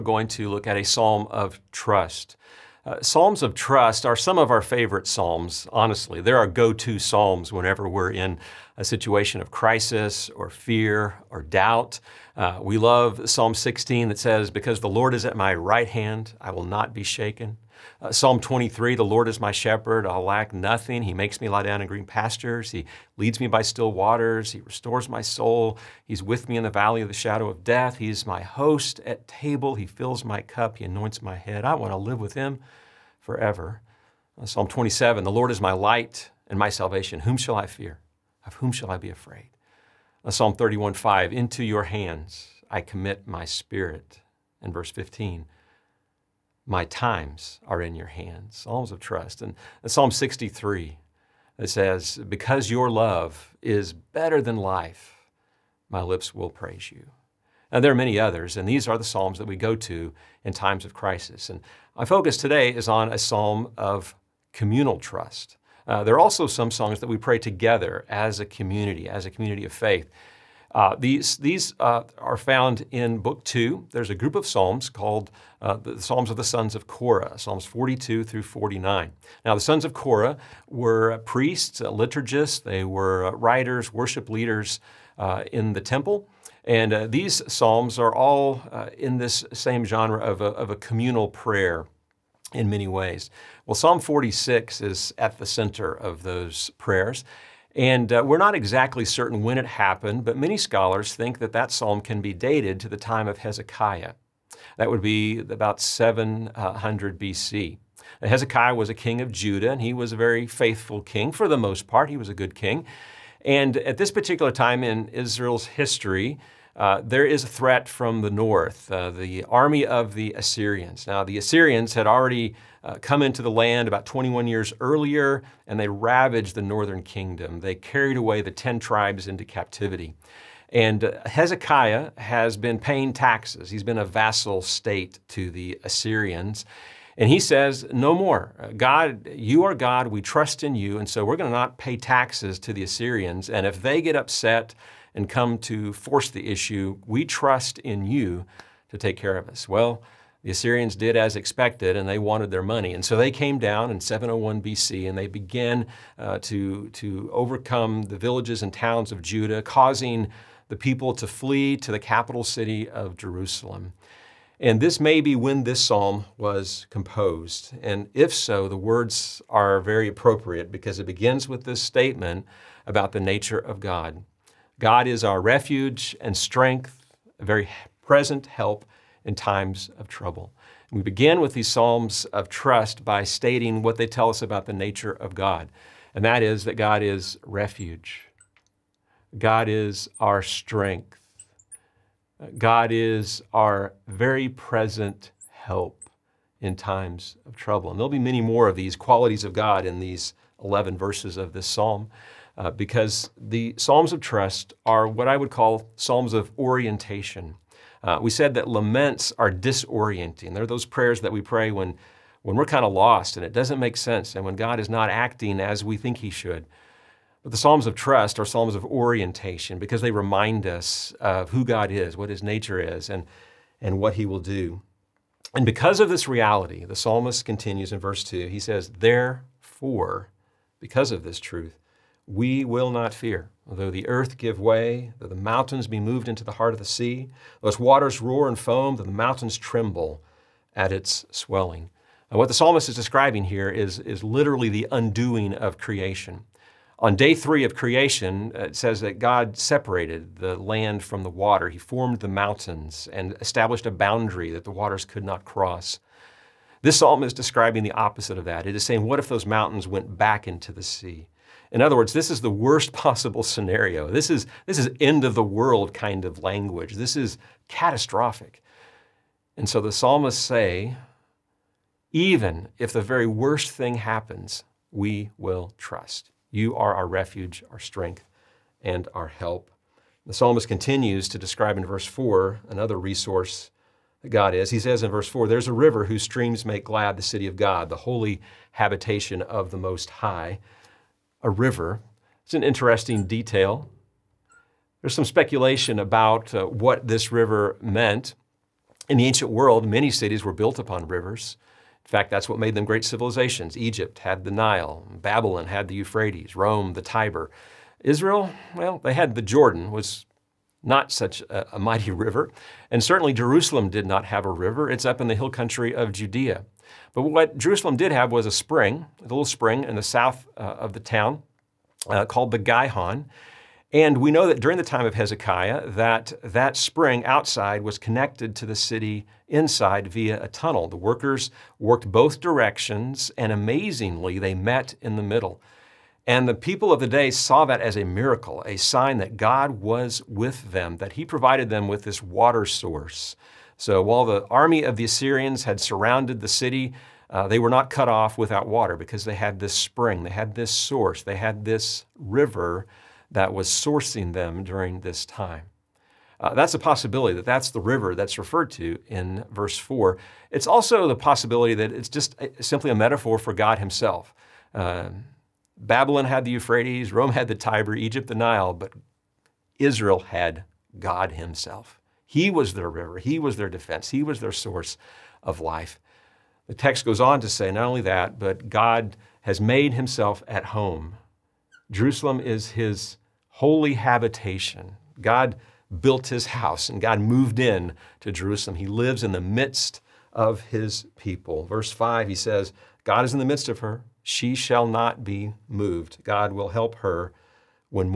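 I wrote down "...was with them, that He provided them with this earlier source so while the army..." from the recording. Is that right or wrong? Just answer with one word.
wrong.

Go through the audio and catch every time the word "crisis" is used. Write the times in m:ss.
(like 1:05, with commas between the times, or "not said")
0:09, 1:00.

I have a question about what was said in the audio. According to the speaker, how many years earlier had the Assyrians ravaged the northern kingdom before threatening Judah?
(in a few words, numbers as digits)
21.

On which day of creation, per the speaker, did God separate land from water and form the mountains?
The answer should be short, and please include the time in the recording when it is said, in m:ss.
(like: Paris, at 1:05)
Day three, at 4:07.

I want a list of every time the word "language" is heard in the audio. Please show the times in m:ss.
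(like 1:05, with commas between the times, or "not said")
4:26.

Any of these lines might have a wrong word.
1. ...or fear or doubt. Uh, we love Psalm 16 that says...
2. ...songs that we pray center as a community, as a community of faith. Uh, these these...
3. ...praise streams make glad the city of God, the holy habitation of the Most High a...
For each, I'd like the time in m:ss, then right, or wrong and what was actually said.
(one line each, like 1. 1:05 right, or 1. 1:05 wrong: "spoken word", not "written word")
1. 0:10 right
2. 1:06 wrong: "together", not "center"
3. 4:46 wrong: "whose", not "praise".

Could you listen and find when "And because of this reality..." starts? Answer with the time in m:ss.
3:45.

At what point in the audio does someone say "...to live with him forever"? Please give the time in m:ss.
0:31.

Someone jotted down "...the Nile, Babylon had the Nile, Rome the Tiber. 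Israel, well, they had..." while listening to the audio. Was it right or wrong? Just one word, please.
wrong.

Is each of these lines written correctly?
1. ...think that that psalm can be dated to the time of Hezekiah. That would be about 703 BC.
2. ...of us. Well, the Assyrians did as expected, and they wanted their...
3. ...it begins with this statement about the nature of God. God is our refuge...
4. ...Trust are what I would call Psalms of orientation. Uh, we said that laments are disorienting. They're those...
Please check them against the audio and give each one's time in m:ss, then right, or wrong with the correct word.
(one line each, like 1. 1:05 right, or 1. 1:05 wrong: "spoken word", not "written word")
1. 1:41 wrong: "700", not "703"
2. 2:29 right
3. 2:50 right
4. 3:24 right.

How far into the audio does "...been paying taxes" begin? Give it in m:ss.
2:12.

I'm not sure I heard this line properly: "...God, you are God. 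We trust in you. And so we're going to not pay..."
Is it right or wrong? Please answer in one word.
right.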